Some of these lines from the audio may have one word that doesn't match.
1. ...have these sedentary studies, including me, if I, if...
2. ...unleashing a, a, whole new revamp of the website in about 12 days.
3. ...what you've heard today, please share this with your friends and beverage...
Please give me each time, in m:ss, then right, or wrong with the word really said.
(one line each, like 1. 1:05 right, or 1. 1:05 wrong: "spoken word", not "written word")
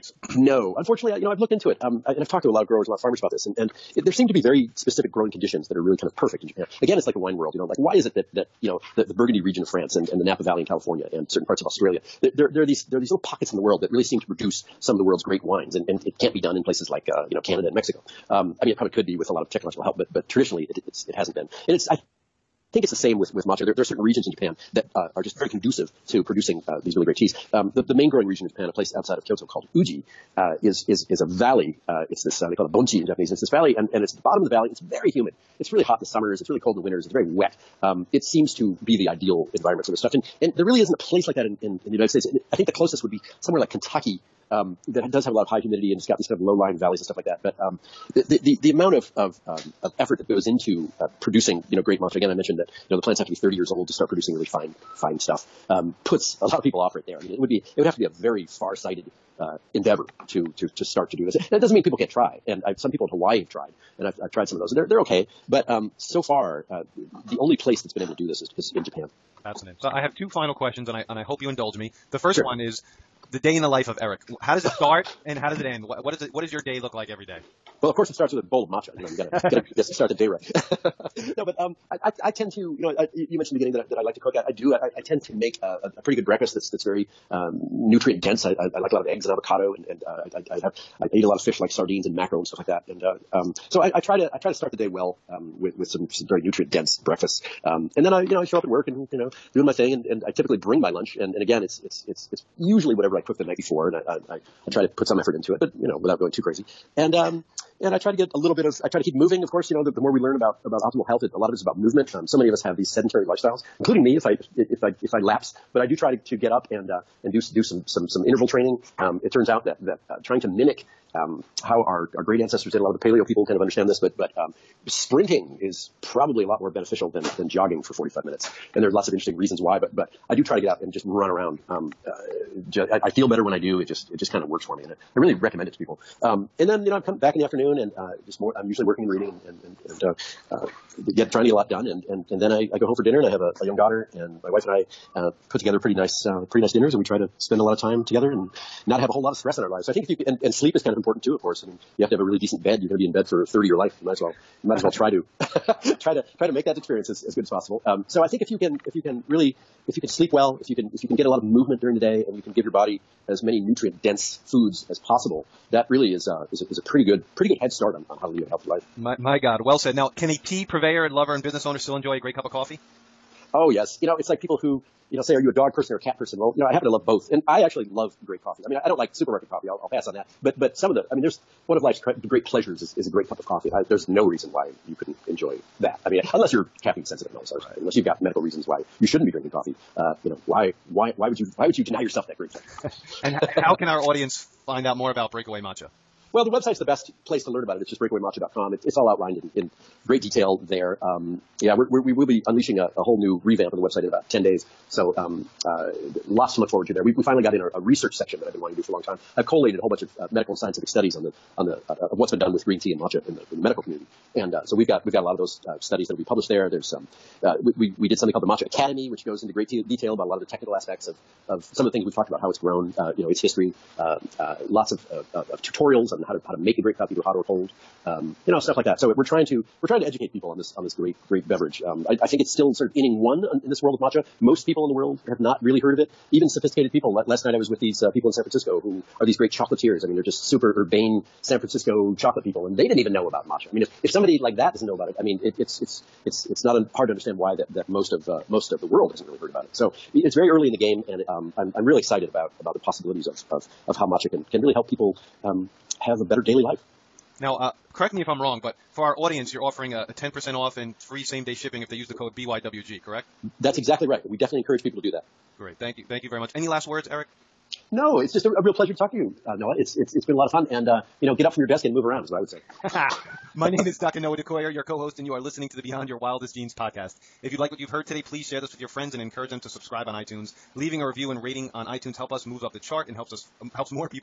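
1. 1:52 wrong: "lifestyles", not "studies"
2. 3:22 wrong: "10", not "12"
3. 4:37 wrong: "encourage", not "beverage".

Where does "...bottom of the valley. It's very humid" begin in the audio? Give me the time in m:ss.
0:34.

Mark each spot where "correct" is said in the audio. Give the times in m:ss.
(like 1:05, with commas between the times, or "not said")
4:17, 4:23.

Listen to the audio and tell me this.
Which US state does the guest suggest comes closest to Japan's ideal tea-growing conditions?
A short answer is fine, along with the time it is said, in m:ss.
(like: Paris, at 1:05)
Kentucky, at 0:43.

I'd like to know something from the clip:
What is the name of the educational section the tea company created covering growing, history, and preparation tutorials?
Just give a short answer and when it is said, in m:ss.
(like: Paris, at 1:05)
Matcha Academy, at 3:38.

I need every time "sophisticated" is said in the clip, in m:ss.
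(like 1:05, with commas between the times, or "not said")
3:56.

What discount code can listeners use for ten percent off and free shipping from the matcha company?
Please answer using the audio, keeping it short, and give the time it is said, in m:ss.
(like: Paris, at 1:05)
BYWG, at 4:22.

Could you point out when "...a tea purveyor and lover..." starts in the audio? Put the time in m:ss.
2:50.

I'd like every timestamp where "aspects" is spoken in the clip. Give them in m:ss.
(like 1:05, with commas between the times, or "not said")
3:40.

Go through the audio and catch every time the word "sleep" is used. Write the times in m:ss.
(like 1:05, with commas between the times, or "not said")
2:30, 2:40.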